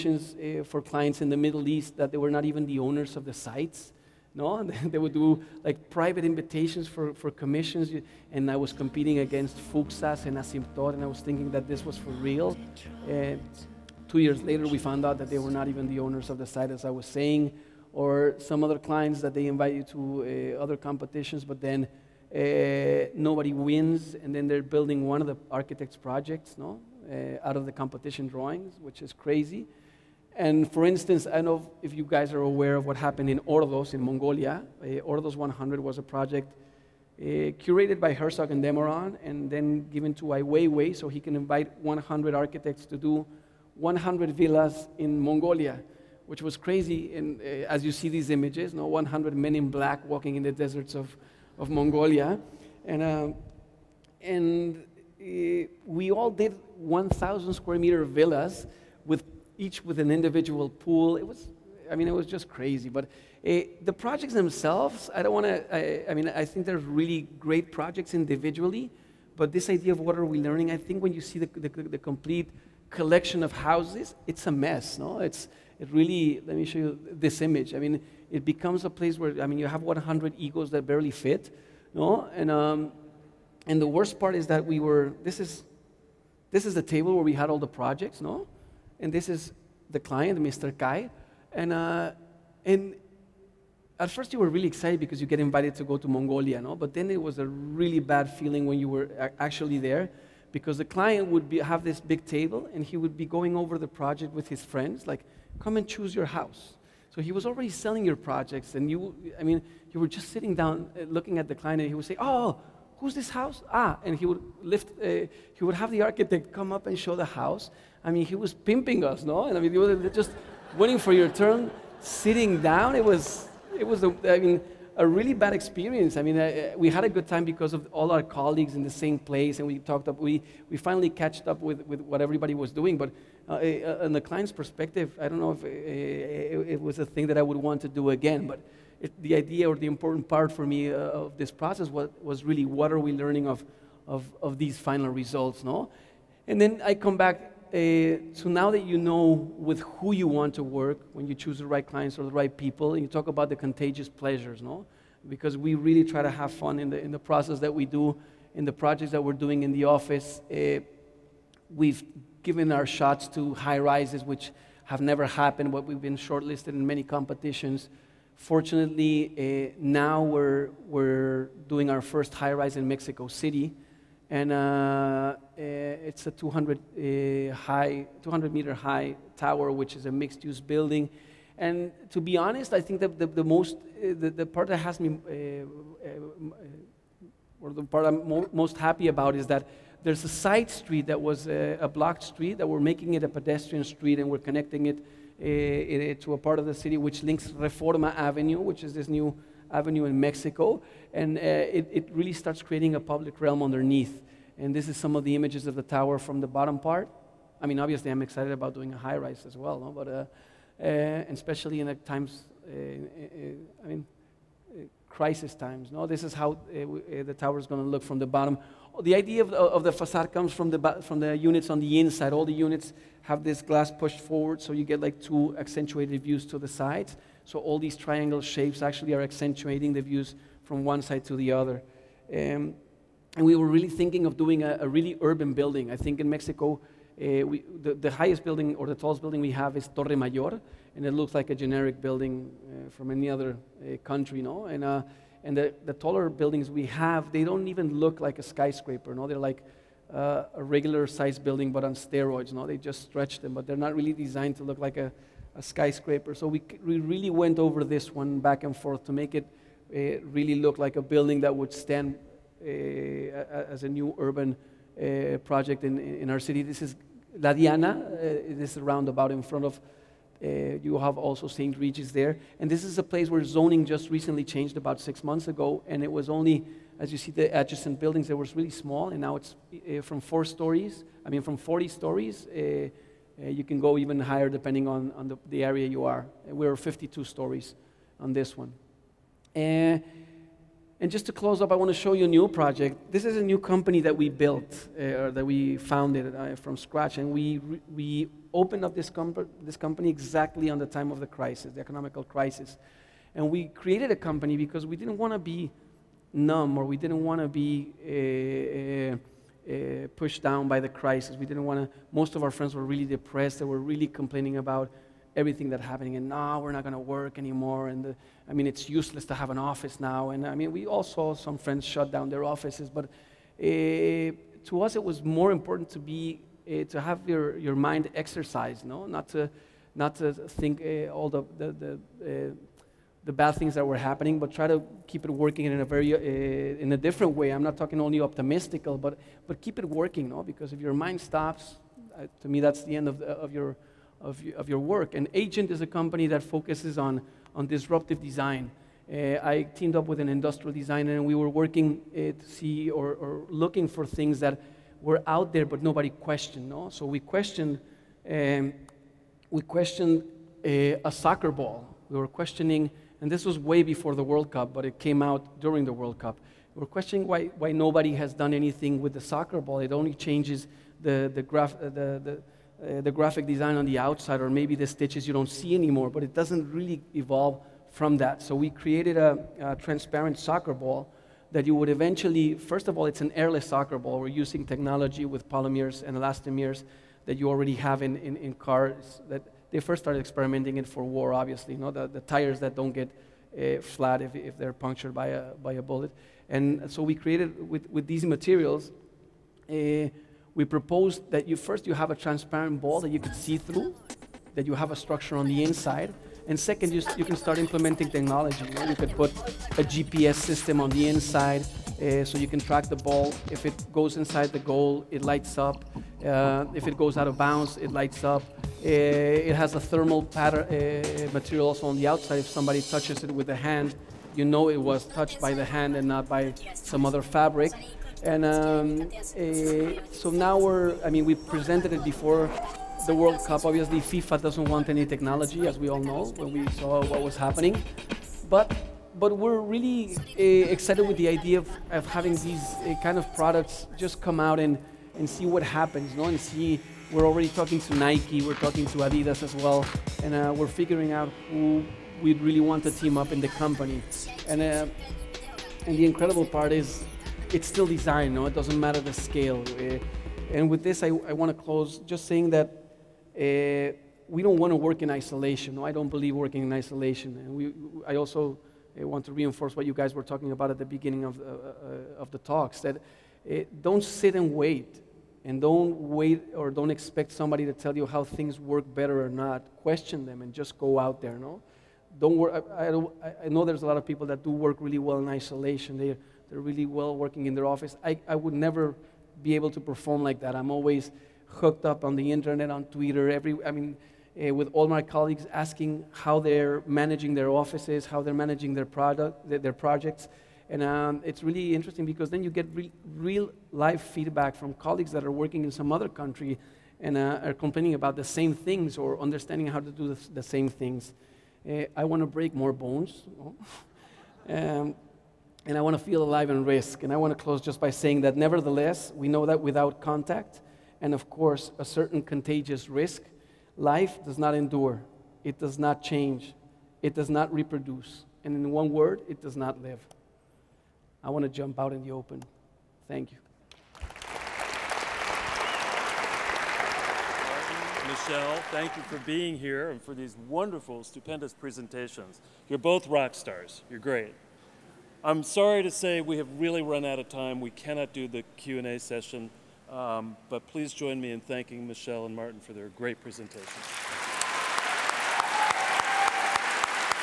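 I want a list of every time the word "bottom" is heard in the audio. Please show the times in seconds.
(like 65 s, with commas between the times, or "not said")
206 s, 218 s.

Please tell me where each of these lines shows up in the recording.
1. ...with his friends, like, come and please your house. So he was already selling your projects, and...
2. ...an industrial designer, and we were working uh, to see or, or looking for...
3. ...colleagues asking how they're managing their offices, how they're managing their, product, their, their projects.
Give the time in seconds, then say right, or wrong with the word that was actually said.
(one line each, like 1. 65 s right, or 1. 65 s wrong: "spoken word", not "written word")
1. 104 s wrong: "choose", not "please"
2. 350 s right
3. 495 s right.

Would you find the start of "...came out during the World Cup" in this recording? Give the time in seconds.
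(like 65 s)
364 s.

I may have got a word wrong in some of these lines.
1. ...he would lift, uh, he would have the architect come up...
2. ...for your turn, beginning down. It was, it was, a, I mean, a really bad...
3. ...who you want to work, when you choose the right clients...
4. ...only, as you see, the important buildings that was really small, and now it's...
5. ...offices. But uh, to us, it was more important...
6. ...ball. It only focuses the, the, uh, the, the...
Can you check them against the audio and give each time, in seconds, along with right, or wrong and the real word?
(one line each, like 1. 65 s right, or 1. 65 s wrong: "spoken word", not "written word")
1. 114 s right
2. 120 s wrong: "sitting", not "beginning"
3. 149 s right
4. 276 s wrong: "adjacent", not "important"
5. 322 s right
6. 369 s wrong: "changes", not "focuses".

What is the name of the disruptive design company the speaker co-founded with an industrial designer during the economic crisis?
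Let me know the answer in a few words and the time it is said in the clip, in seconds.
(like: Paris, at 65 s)
Agent, at 345 s.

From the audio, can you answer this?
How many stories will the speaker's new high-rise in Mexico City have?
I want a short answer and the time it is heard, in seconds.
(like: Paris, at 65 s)
52, at 286 s.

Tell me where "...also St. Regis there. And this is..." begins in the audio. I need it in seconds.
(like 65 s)
271 s.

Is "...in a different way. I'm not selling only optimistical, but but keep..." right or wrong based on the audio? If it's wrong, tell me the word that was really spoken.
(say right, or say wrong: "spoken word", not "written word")
wrong: "talking", not "selling".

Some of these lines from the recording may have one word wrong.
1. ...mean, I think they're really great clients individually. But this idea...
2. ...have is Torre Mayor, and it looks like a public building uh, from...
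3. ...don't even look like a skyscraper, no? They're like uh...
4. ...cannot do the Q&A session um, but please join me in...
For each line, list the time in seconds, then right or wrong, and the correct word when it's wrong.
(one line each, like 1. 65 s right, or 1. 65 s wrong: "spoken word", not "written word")
1. 66 s wrong: "projects", not "clients"
2. 239 s wrong: "generic", not "public"
3. 247 s right
4. 547 s right.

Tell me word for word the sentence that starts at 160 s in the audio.
Uh, we've given our shots to high rises, which have never happened, but we've been shortlisted in many competitions.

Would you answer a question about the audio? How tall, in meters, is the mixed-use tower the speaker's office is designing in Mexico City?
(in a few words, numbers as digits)
200 meters.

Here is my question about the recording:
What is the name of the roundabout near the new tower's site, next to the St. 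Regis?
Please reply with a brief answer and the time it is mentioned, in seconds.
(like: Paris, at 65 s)
La Diana, at 267 s.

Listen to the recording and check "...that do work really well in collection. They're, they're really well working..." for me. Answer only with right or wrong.
wrong.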